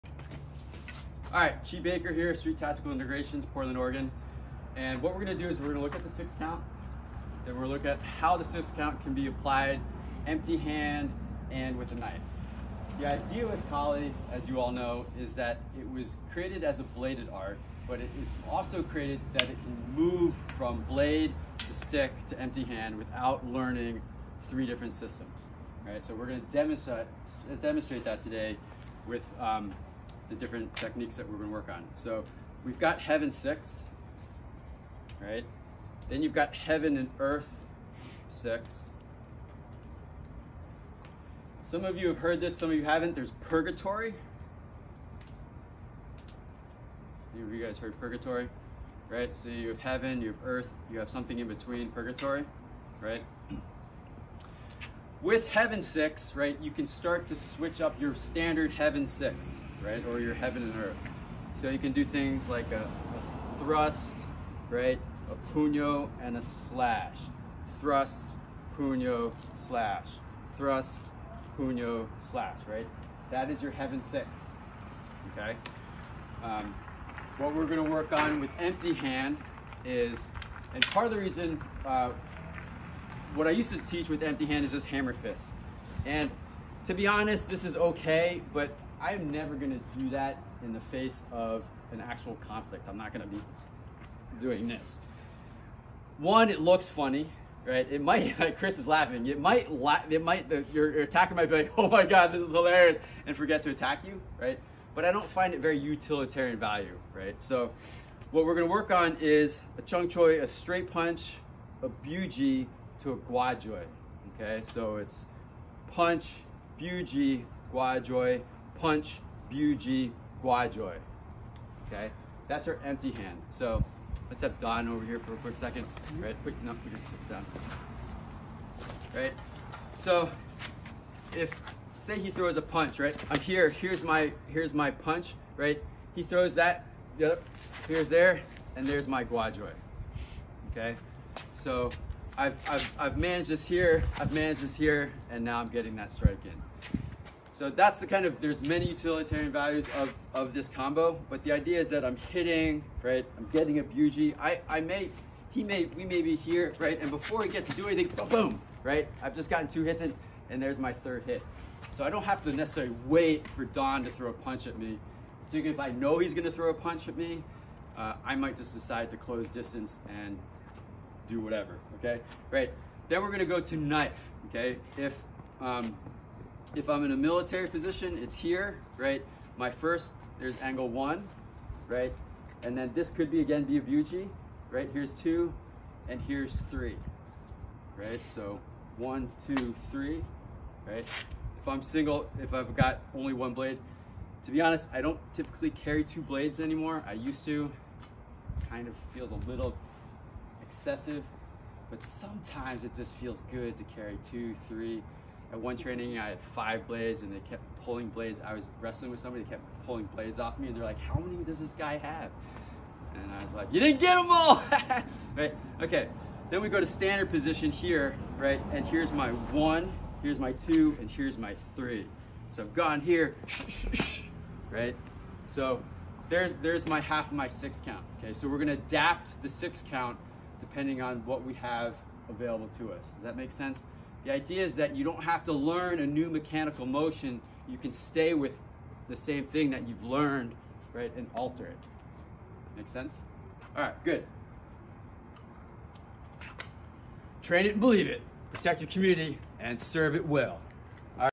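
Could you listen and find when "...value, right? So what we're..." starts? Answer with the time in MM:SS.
01:46.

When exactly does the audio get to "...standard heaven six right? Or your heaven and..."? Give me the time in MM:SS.
00:58.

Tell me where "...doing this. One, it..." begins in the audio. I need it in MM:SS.
01:34.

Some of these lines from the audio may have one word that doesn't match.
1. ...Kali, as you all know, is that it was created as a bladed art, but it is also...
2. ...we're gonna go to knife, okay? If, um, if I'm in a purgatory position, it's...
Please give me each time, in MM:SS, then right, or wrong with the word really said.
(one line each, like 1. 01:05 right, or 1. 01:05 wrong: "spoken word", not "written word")
1. 00:13 right
2. 02:53 wrong: "military", not "purgatory".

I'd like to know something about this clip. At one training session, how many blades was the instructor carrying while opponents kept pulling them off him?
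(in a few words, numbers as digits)
5.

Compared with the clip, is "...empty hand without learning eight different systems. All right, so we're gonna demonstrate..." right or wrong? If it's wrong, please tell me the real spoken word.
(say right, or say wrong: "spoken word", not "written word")
wrong: "three", not "eight".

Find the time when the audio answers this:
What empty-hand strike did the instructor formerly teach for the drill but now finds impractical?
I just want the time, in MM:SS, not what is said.
01:24.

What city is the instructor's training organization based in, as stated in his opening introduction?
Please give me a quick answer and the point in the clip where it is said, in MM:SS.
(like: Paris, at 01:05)
Portland, Oregon, at 00:03.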